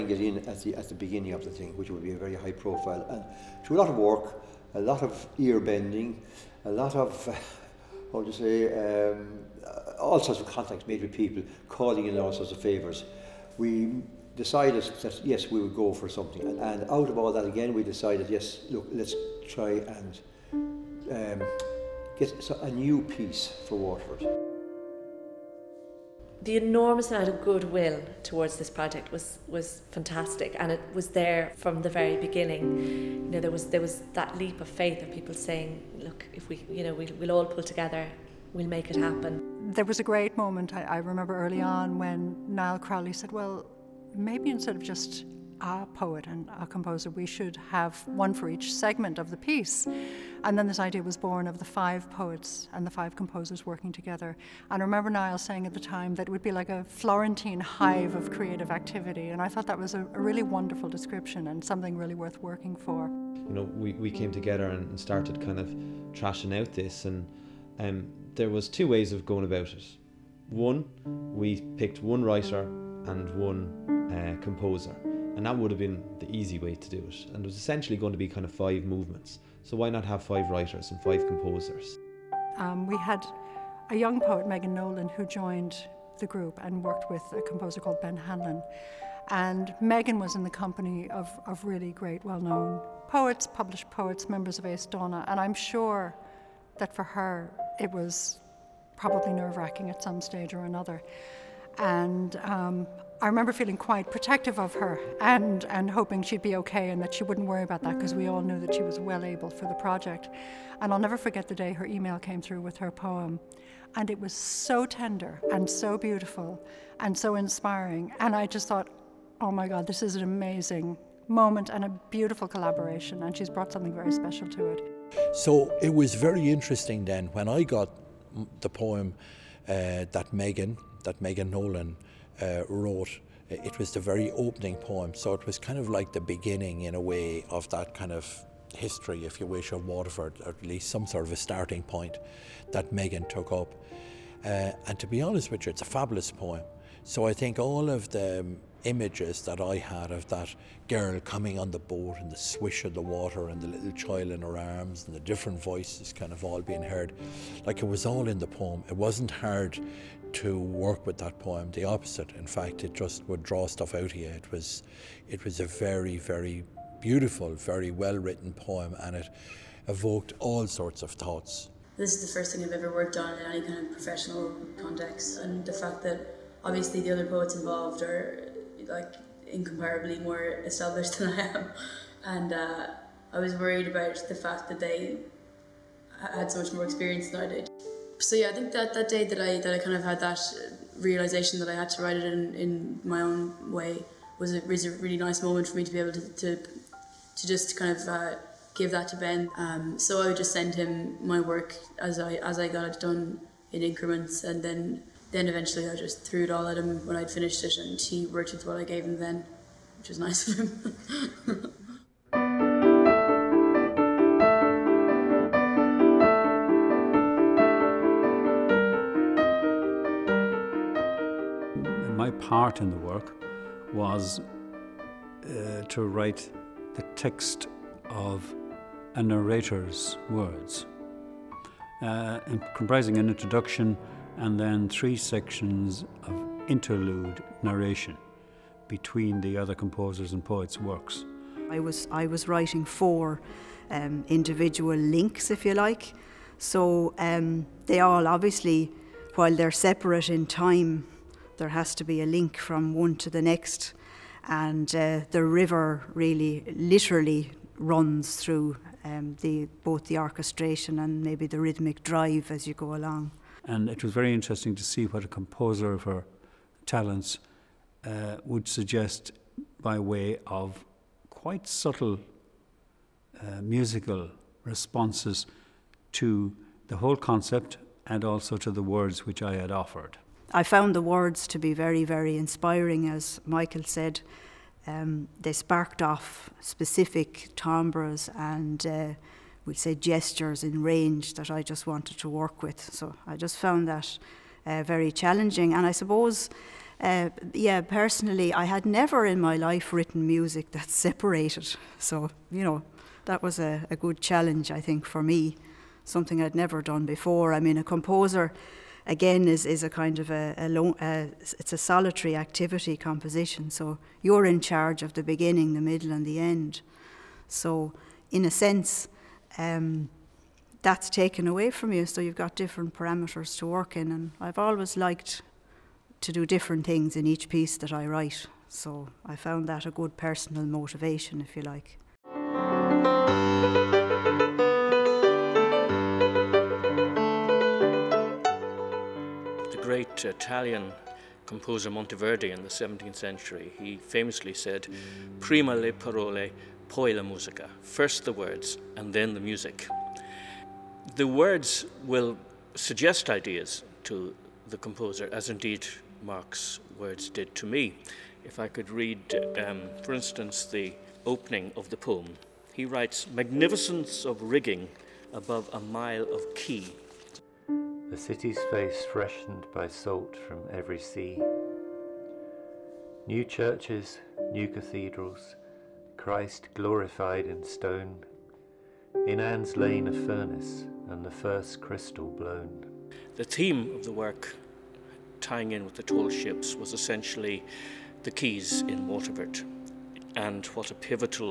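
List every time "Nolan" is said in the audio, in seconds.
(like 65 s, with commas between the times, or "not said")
84 s, 131 s.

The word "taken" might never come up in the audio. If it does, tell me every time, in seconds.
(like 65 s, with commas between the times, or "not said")
321 s.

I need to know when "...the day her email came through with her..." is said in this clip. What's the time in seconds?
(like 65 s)
111 s.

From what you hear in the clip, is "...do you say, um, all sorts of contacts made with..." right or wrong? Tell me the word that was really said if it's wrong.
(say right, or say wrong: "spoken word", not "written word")
right.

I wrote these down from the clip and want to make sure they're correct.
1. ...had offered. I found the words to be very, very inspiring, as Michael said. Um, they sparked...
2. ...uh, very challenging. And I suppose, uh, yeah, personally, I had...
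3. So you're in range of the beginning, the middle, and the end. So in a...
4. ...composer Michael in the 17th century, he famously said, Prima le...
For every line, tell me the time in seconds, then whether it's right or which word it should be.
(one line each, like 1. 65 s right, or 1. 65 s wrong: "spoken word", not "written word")
1. 279 s right
2. 294 s right
3. 313 s wrong: "charge", not "range"
4. 341 s wrong: "Monteverdi", not "Michael".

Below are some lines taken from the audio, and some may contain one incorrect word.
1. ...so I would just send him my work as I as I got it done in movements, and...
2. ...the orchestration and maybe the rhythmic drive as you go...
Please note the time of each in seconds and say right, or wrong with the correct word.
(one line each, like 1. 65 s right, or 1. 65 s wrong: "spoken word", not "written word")
1. 199 s wrong: "increments", not "movements"
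2. 260 s right.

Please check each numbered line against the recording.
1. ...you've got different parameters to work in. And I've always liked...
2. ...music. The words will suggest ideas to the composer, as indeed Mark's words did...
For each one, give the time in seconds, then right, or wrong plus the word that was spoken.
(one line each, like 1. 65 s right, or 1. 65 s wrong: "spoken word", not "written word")
1. 322 s right
2. 349 s right.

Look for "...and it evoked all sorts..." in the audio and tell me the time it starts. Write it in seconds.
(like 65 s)
168 s.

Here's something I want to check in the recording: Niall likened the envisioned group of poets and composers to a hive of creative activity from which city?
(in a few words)
Florentine.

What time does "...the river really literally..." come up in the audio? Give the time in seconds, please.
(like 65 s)
255 s.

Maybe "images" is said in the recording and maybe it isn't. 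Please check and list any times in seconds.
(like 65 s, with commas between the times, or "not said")
148 s.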